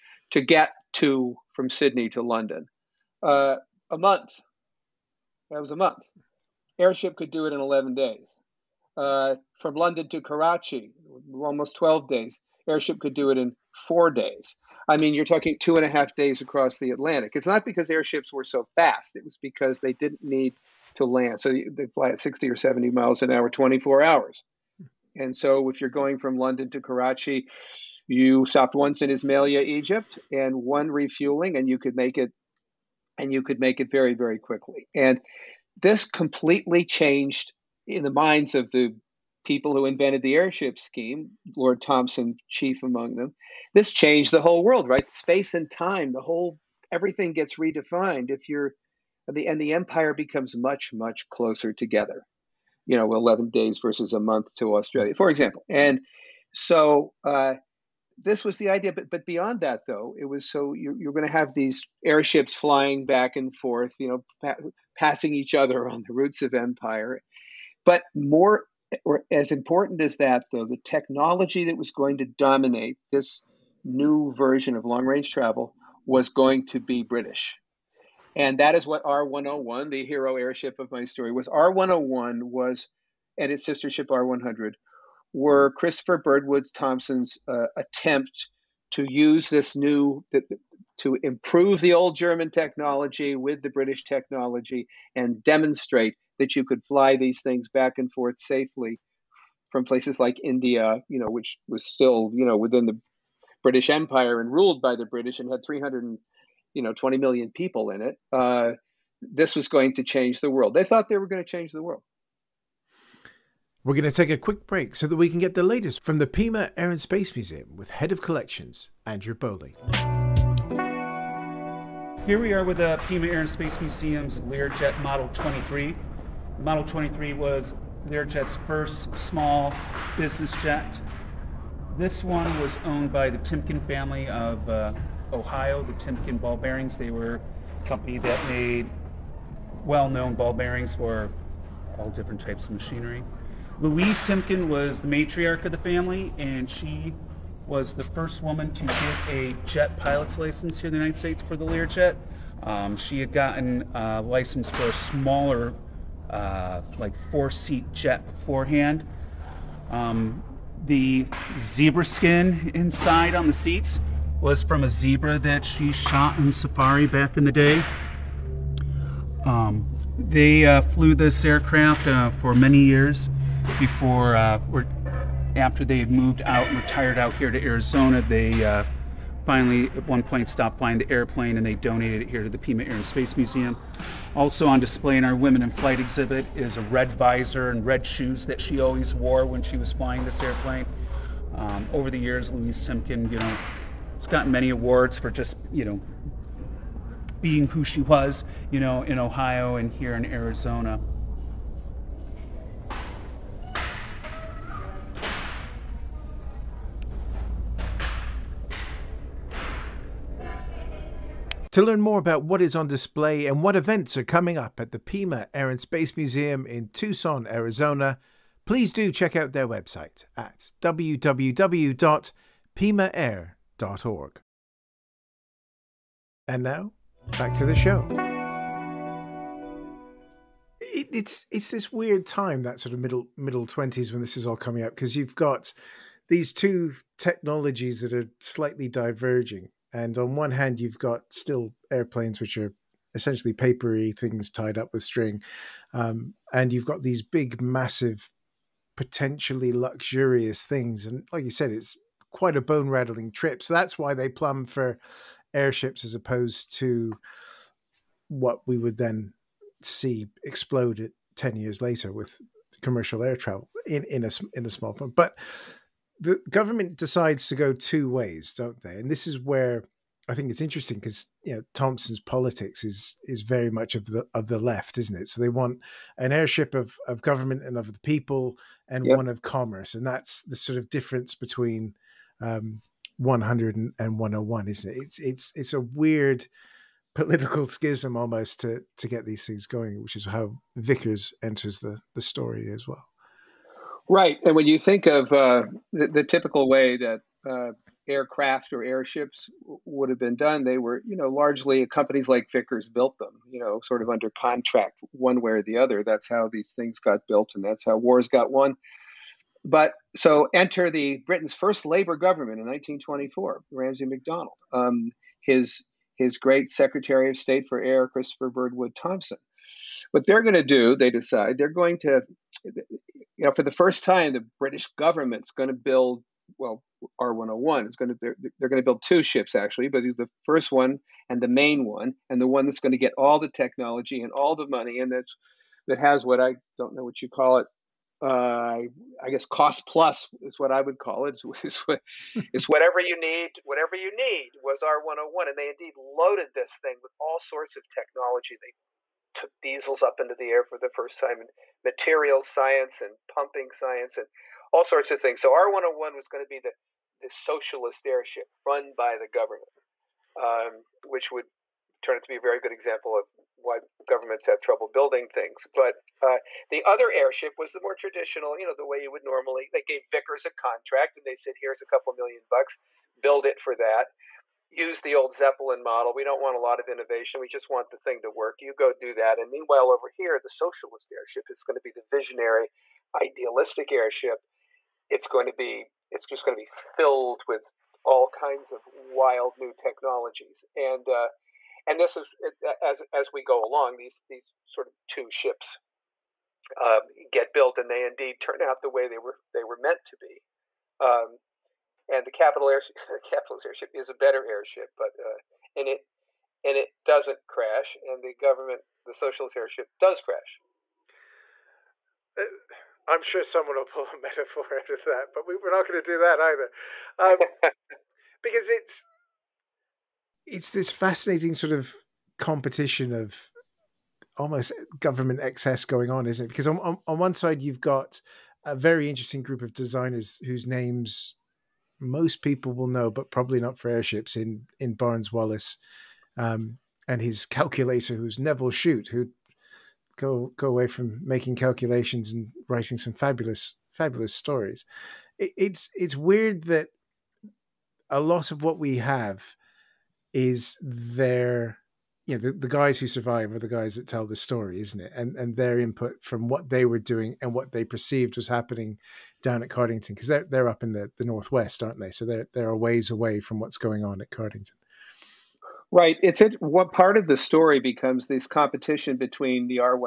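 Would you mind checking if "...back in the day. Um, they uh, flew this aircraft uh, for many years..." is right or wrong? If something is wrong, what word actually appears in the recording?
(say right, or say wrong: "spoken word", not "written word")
right.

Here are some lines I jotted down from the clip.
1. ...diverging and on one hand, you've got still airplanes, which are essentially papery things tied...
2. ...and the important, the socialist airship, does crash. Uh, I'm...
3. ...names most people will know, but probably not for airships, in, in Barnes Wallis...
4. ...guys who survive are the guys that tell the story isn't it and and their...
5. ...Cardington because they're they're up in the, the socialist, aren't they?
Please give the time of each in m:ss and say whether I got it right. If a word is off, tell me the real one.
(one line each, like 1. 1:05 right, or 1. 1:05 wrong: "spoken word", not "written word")
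1. 3:58 right
2. 6:48 wrong: "government", not "important"
3. 7:10 right
4. 7:32 right
5. 7:39 wrong: "northwest", not "socialist".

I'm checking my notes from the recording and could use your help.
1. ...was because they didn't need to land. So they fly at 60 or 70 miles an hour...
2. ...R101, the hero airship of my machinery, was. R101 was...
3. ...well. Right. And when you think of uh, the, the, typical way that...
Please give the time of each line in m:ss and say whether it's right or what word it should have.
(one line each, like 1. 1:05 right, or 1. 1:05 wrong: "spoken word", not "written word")
1. 0:19 right
2. 1:19 wrong: "story", not "machinery"
3. 4:52 right.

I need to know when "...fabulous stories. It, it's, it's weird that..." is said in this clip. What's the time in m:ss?
7:23.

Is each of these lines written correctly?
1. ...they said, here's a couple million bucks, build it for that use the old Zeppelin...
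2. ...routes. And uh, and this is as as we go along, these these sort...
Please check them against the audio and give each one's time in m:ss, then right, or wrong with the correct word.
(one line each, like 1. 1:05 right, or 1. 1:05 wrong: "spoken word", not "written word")
1. 6:11 right
2. 6:29 wrong: "technologies", not "routes".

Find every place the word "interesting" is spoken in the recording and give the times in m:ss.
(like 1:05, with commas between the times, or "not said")
4:30, 7:09.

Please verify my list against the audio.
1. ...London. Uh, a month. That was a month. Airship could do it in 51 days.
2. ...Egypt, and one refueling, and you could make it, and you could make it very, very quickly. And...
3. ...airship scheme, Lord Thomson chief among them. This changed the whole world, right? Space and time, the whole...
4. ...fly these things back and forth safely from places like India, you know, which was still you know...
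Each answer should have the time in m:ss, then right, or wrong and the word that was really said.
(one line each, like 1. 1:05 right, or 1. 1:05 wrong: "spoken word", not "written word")
1. 0:02 wrong: "11", not "51"
2. 0:29 right
3. 0:40 right
4. 1:36 right.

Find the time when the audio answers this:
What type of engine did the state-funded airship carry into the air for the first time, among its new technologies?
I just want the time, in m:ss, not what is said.
5:49.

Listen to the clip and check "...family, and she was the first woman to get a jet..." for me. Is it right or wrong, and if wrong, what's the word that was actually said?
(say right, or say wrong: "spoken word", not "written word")
right.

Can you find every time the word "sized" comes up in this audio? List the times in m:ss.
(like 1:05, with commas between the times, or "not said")
not said.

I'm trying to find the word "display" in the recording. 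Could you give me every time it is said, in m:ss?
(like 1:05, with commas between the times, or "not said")
3:04, 3:32.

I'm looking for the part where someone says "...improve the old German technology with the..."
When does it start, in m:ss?
1:31.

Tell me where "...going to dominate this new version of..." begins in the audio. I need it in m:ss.
1:11.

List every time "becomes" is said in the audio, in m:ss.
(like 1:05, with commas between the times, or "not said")
0:50, 7:47.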